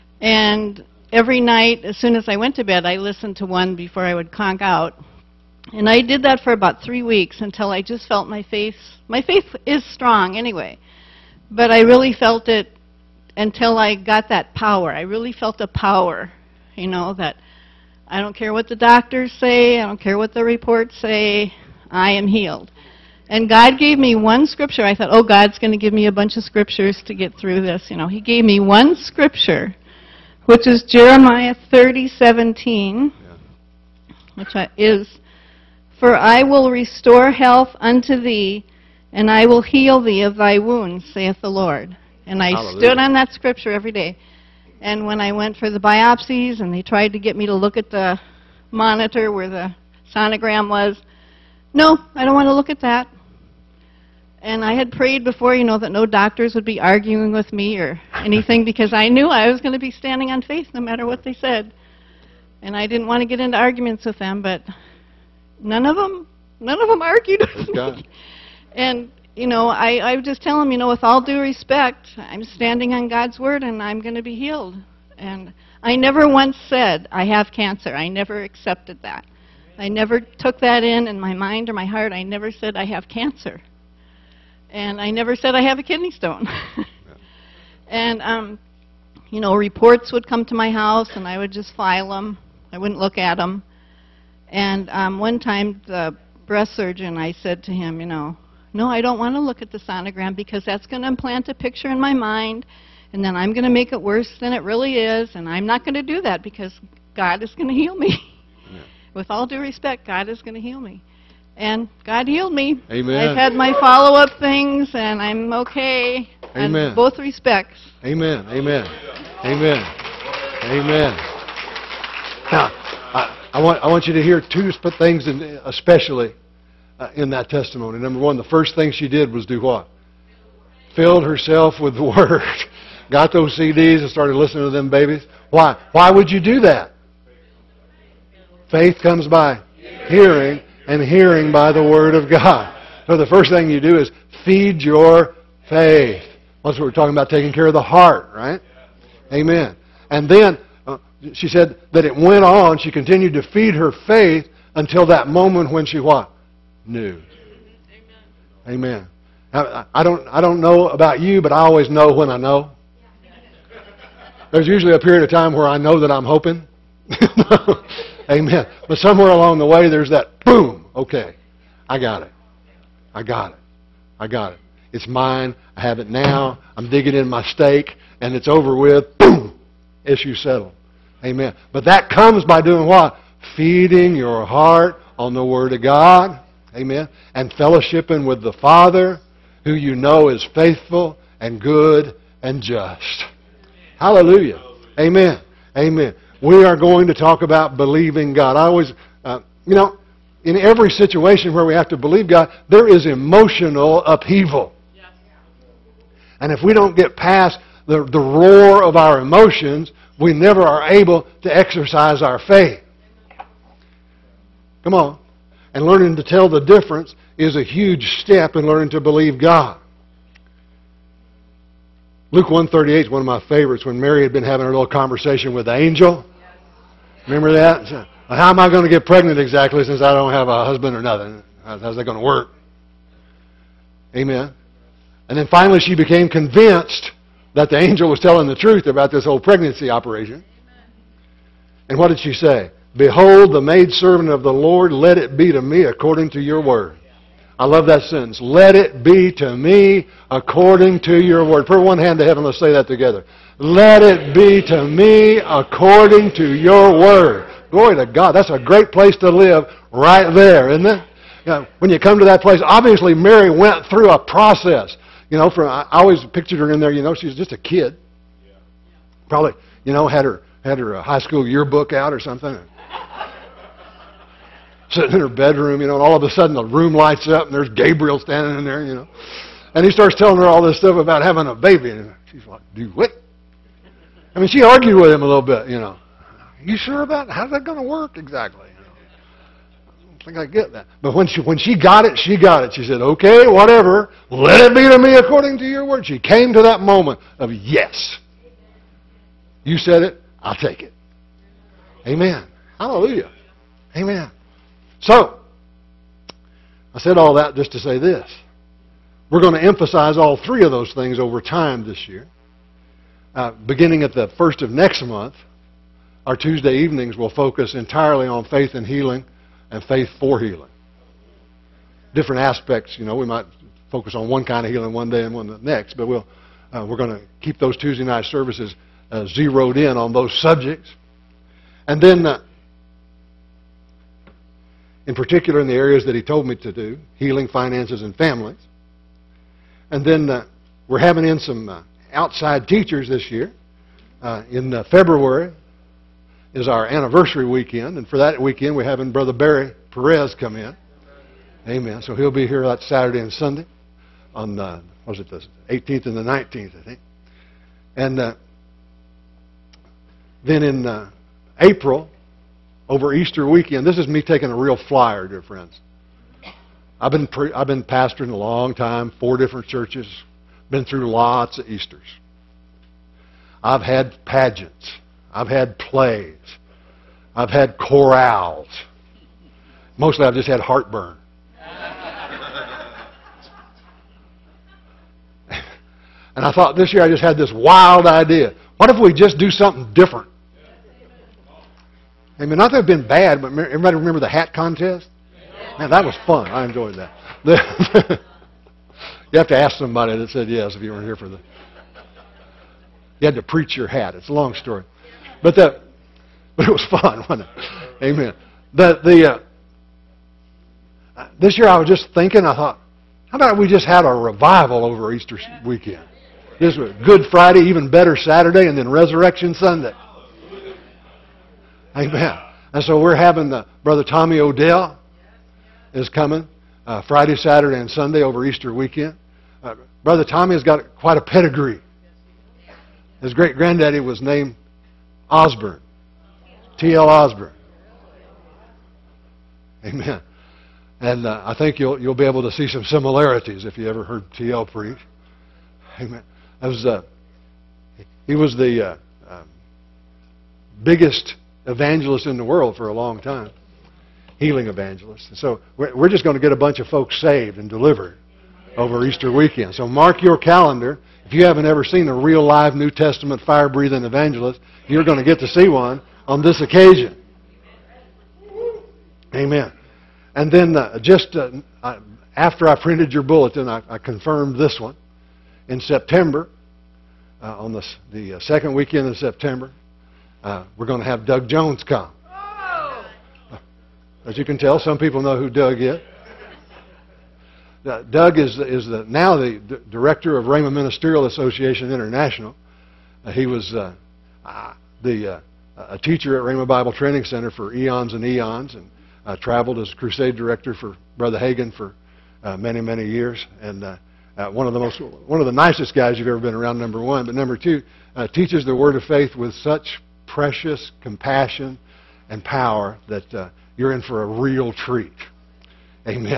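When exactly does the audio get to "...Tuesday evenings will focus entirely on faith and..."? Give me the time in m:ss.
5:16.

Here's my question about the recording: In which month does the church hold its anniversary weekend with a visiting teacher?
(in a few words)
February.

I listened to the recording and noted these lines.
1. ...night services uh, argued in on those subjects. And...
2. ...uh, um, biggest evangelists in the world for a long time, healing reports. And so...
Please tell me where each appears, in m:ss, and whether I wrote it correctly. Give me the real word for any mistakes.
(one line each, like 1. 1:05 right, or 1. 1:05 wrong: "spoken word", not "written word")
1. 5:28 wrong: "zeroed", not "argued"
2. 7:28 wrong: "evangelists", not "reports".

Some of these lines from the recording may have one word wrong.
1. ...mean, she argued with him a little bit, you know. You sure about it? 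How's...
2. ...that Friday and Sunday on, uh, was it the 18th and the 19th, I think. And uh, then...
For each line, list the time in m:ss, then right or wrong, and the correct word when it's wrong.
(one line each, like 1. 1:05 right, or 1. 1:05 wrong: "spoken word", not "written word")
1. 4:44 right
2. 5:52 wrong: "Saturday", not "Friday".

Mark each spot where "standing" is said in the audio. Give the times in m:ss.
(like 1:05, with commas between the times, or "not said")
0:59, 1:12, 4:38.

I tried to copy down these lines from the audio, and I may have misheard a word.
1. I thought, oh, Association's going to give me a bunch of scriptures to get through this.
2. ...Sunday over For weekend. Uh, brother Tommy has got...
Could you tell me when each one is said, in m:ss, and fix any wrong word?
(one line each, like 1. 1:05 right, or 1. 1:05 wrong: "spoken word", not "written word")
1. 0:24 wrong: "God", not "Association"
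2. 7:07 wrong: "Easter", not "For".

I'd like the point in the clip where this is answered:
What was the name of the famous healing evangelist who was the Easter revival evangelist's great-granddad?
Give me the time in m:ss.
7:16.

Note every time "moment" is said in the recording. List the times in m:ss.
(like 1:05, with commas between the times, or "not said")
2:35, 4:56.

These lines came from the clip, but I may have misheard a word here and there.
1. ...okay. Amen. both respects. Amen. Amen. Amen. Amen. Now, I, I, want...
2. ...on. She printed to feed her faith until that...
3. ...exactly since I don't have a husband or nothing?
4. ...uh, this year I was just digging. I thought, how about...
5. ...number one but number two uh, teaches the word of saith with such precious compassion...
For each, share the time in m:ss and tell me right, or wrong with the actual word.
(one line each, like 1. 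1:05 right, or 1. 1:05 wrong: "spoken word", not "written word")
1. 1:55 right
2. 2:32 wrong: "continued", not "printed"
3. 3:49 right
4. 6:51 wrong: "thinking", not "digging"
5. 8:26 wrong: "faith", not "saith".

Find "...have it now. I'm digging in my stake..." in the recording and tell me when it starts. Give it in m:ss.
2:55.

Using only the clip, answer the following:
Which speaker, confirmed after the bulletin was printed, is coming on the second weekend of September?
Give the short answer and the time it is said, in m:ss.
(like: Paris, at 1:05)
Doug Jones, at 8:01.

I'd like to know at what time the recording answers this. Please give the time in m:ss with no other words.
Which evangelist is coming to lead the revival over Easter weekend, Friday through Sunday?
7:04.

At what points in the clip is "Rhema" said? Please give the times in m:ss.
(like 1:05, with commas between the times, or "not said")
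8:10, 8:16.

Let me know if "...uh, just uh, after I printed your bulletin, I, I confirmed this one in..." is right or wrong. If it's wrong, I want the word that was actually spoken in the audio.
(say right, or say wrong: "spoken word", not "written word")
right.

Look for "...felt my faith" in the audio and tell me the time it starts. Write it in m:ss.
0:08.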